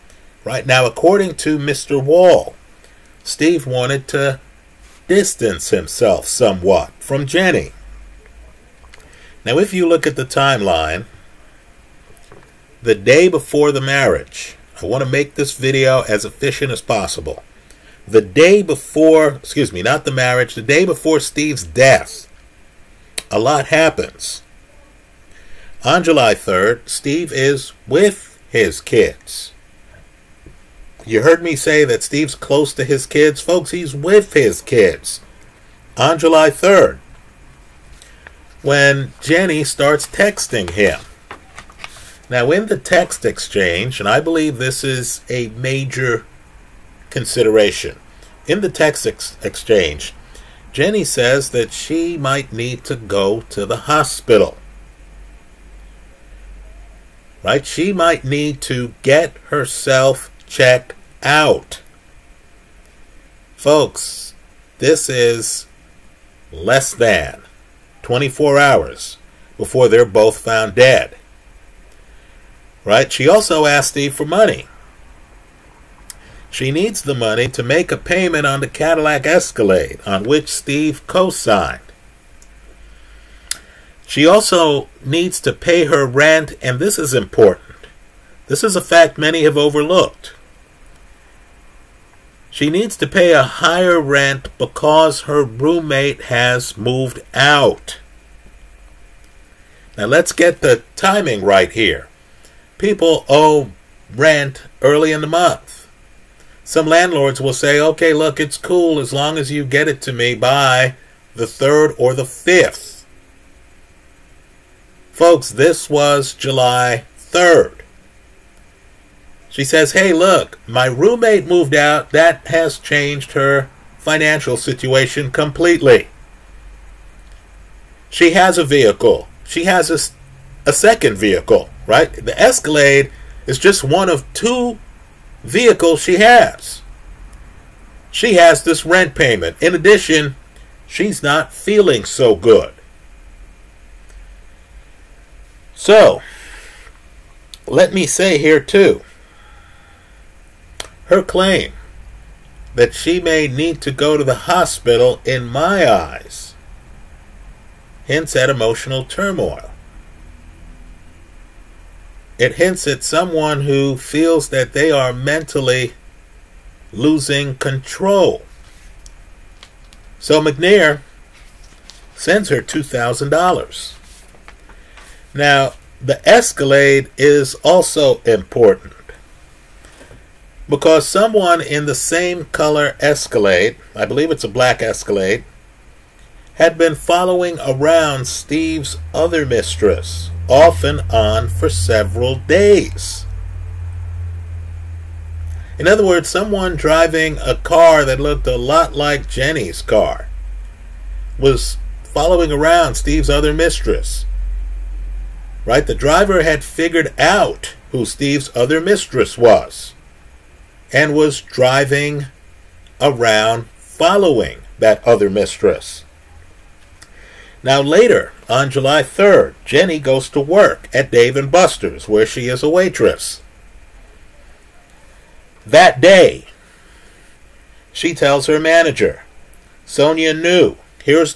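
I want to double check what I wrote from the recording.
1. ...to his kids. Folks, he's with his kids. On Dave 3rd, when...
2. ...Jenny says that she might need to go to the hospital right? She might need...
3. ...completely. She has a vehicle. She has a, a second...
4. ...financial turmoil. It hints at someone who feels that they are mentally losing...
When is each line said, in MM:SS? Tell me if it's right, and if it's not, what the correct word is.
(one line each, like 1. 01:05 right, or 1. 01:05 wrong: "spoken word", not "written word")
1. 00:32 wrong: "July", not "Dave"
2. 00:50 right
3. 02:05 right
4. 02:38 wrong: "emotional", not "financial".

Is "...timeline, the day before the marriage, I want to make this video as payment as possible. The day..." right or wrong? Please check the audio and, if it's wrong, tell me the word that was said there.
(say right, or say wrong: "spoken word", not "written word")
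wrong: "efficient", not "payment".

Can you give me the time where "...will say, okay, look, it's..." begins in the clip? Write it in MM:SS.
01:47.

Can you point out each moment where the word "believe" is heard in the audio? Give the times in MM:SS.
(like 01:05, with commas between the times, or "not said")
00:44, 03:04.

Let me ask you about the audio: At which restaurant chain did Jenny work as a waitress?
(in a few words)
Dave and Buster's.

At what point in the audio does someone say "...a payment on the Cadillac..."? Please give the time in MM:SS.
01:17.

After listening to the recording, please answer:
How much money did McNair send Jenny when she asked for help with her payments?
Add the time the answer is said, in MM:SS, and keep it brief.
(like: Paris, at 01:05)
$2,000, at 02:52.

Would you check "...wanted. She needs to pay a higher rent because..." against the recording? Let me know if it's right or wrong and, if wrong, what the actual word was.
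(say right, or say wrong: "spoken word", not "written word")
wrong: "overlooked", not "wanted".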